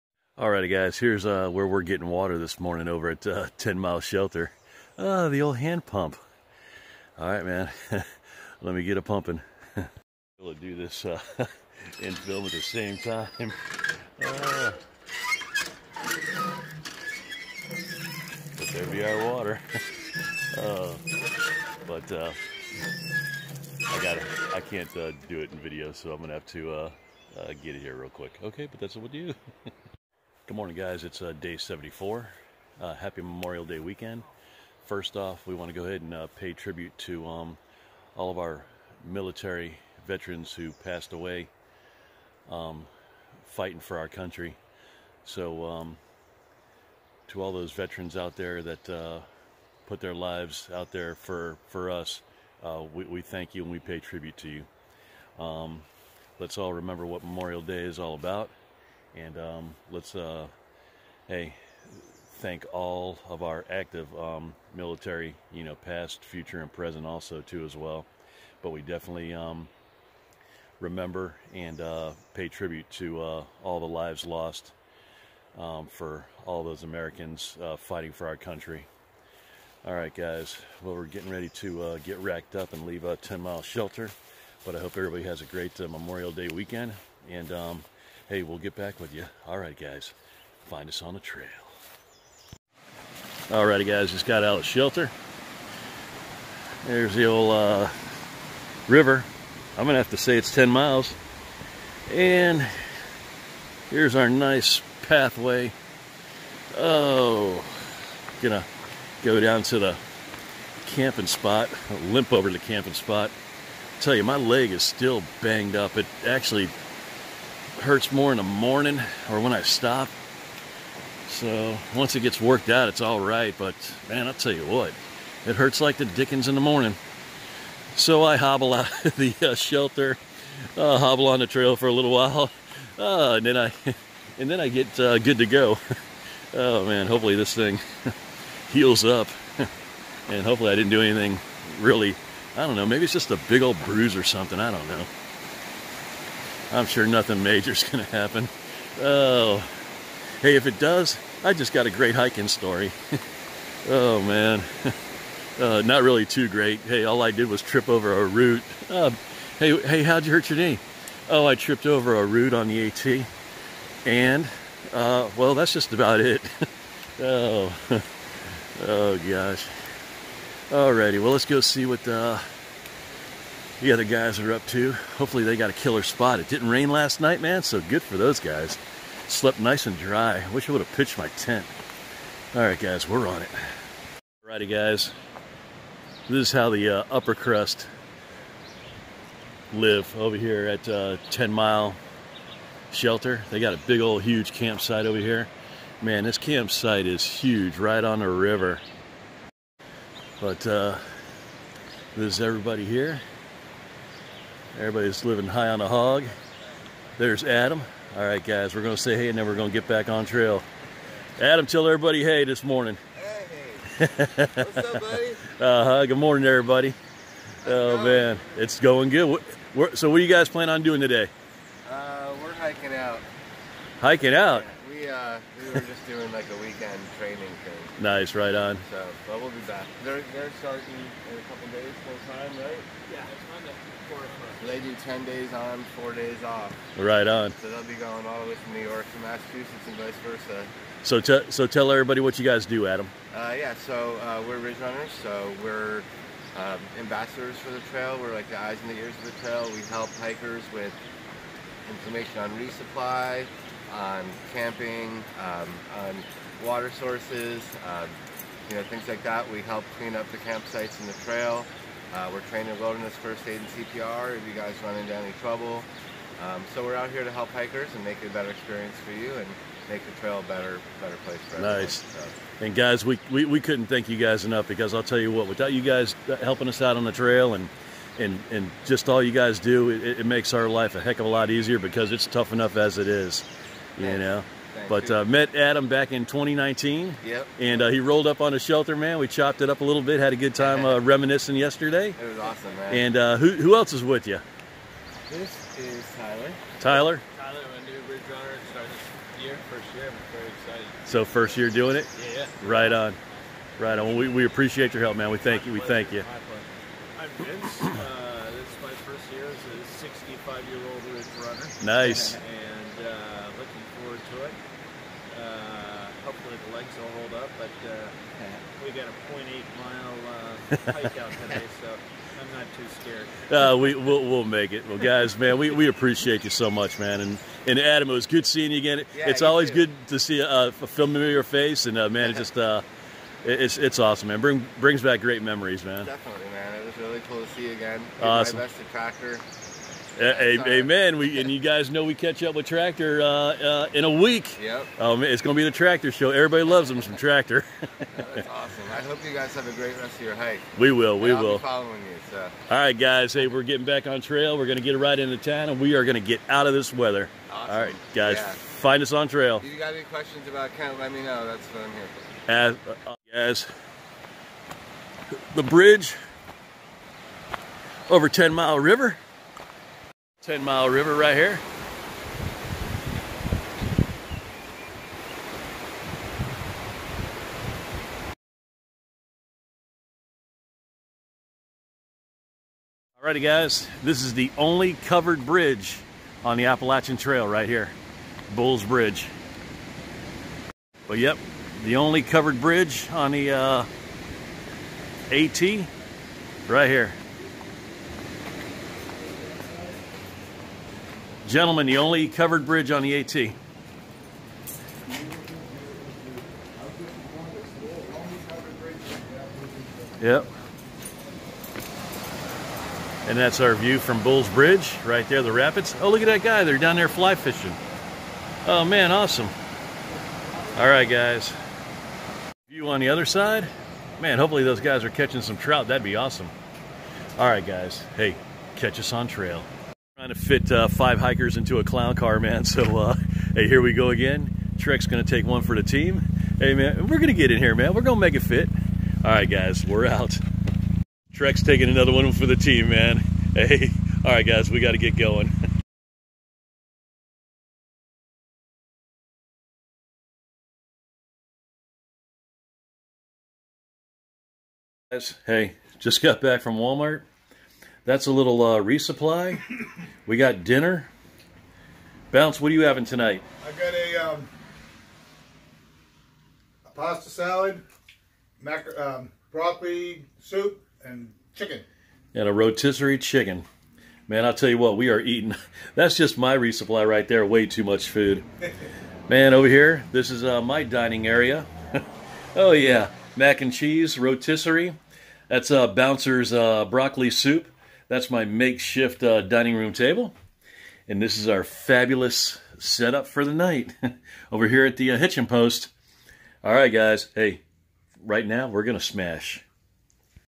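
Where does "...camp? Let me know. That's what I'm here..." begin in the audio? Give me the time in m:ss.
6:00.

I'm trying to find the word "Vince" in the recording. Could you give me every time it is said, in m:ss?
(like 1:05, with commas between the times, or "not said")
5:07.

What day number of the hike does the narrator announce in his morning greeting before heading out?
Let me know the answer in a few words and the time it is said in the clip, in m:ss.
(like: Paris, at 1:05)
74, at 0:31.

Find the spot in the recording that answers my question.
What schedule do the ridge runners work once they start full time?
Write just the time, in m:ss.
3:54.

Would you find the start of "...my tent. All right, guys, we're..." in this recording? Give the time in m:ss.
3:01.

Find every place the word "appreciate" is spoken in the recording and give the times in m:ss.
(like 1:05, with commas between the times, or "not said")
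5:04, 5:25.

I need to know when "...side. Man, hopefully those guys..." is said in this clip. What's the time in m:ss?
7:03.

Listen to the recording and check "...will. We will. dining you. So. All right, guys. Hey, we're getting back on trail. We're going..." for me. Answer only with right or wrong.
wrong.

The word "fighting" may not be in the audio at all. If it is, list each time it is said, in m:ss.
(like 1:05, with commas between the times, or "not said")
0:43, 1:17.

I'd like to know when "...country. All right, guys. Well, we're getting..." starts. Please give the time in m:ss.
1:18.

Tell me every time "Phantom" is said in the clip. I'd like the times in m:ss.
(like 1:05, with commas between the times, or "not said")
not said.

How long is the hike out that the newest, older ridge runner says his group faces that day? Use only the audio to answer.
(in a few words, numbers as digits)
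0.8 mile.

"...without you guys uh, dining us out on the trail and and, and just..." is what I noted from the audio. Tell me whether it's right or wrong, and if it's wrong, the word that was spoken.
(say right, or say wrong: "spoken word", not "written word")
wrong: "helping", not "dining".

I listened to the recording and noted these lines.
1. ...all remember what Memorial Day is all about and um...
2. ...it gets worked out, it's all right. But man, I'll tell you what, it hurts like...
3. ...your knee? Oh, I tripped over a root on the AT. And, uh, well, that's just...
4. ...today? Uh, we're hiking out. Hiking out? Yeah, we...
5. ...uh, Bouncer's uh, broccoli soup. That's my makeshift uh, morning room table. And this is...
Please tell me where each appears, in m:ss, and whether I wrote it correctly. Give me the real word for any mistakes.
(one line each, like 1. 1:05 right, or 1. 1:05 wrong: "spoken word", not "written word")
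1. 0:56 right
2. 2:02 right
3. 2:40 right
4. 3:41 right
5. 8:05 wrong: "dining", not "morning".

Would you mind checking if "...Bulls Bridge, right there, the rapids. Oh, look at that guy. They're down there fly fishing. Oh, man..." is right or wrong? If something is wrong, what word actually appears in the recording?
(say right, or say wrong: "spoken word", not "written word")
right.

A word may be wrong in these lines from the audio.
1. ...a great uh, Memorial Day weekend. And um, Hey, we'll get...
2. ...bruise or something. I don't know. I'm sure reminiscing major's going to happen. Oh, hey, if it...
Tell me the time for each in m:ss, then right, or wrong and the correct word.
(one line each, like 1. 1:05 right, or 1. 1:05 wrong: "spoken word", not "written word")
1. 1:25 right
2. 2:23 wrong: "nothing", not "reminiscing".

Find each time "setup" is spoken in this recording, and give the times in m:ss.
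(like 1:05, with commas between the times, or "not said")
8:12.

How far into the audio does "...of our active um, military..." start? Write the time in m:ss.
1:03.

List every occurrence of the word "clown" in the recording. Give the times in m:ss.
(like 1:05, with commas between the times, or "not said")
7:11.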